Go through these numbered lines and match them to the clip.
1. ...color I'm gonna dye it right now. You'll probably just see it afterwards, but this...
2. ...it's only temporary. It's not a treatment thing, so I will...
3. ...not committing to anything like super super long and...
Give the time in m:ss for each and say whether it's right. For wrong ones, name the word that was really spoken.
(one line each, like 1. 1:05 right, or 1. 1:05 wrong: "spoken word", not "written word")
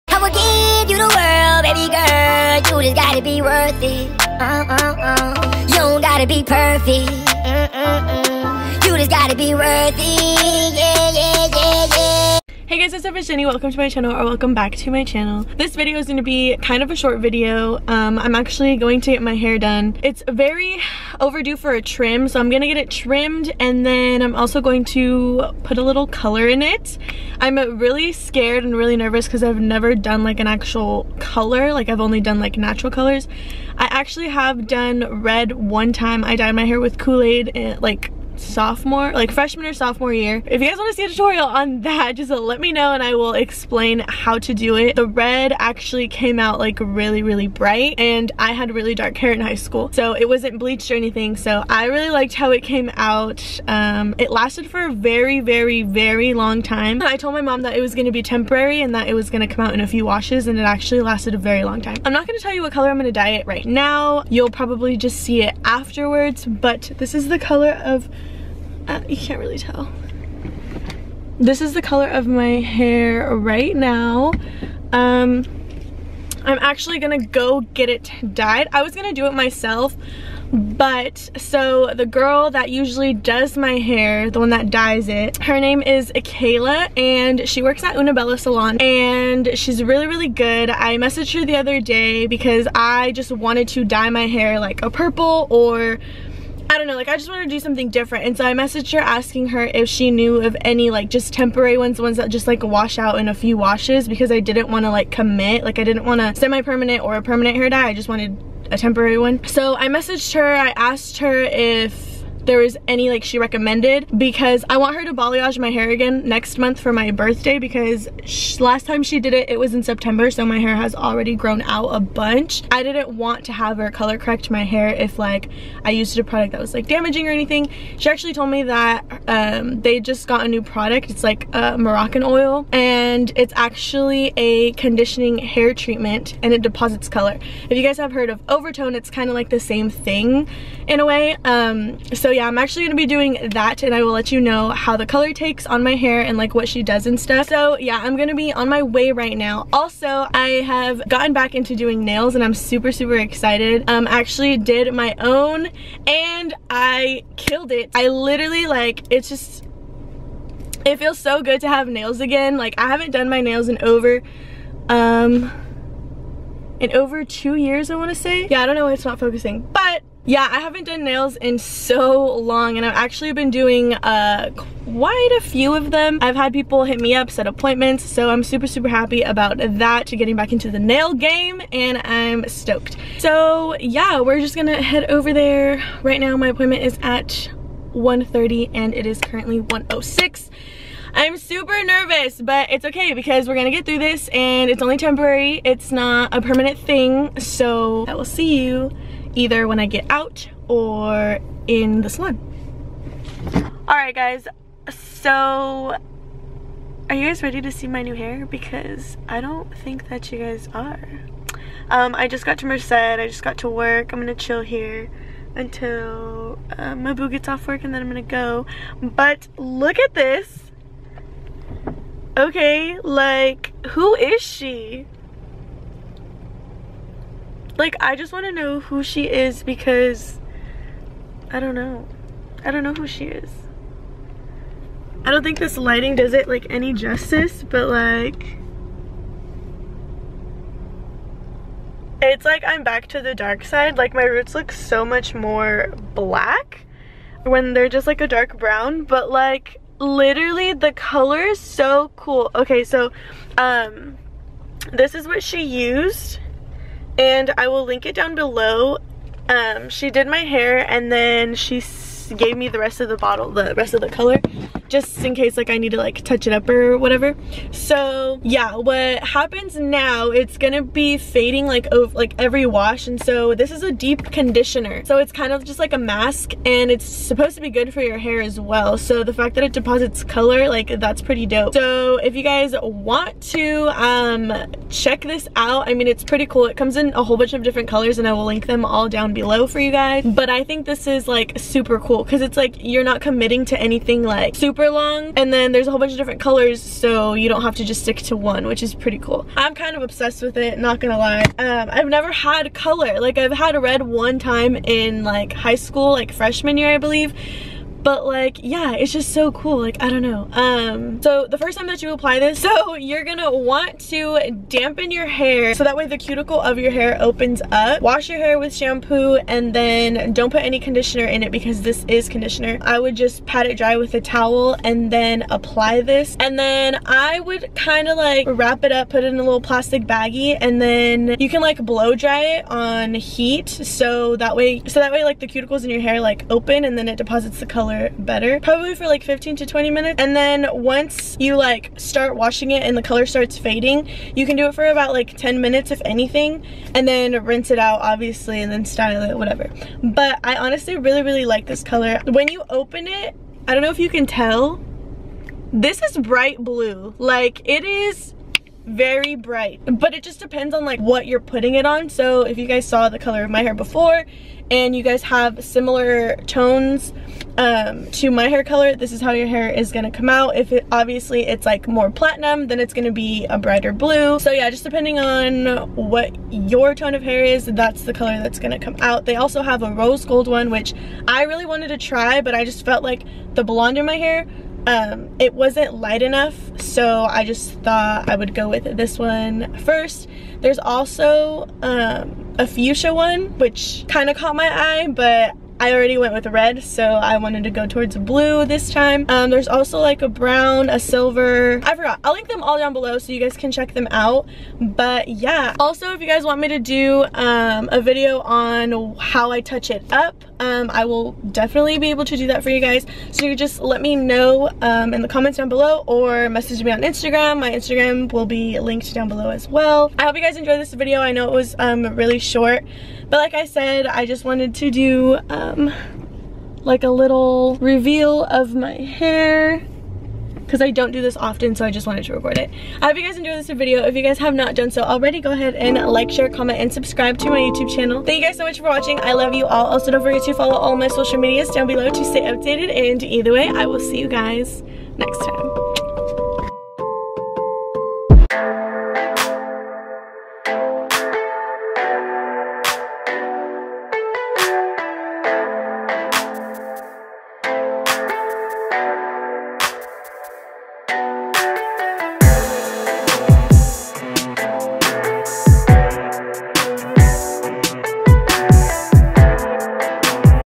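1. 1:02 right
2. 3:14 wrong: "permanent", not "treatment"
3. 4:53 right.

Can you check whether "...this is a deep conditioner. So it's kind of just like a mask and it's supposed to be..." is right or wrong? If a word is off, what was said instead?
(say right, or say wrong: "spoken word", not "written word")
right.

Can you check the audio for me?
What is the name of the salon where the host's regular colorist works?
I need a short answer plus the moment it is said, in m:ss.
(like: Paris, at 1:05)
Unabella Salon, at 1:27.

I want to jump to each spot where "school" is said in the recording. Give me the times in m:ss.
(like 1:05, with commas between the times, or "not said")
0:49, 5:05.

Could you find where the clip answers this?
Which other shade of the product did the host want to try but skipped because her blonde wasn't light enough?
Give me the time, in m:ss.
6:19.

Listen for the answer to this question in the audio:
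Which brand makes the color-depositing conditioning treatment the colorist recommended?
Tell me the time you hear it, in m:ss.
2:11.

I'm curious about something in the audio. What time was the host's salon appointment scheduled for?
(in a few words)
1:30.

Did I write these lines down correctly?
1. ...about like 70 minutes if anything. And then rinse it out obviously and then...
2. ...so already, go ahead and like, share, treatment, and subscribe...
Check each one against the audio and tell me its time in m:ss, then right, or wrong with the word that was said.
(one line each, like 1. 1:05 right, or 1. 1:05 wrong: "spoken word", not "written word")
1. 5:44 wrong: "10", not "70"
2. 7:14 wrong: "comment", not "treatment".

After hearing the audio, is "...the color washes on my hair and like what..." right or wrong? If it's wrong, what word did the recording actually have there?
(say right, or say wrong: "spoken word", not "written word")
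wrong: "takes", not "washes".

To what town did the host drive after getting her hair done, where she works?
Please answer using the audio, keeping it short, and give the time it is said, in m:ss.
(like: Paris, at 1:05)
Merced, at 3:32.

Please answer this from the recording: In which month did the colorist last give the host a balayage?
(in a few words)
September.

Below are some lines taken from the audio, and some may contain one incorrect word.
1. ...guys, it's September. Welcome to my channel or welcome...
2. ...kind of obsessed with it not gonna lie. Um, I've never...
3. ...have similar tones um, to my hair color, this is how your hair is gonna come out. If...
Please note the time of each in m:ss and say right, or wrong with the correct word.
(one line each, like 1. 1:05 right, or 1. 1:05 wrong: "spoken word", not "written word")
1. 0:12 wrong: "Jennie", not "September"
2. 4:59 right
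3. 6:05 right.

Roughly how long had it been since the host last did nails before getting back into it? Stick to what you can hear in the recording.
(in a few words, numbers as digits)
two years.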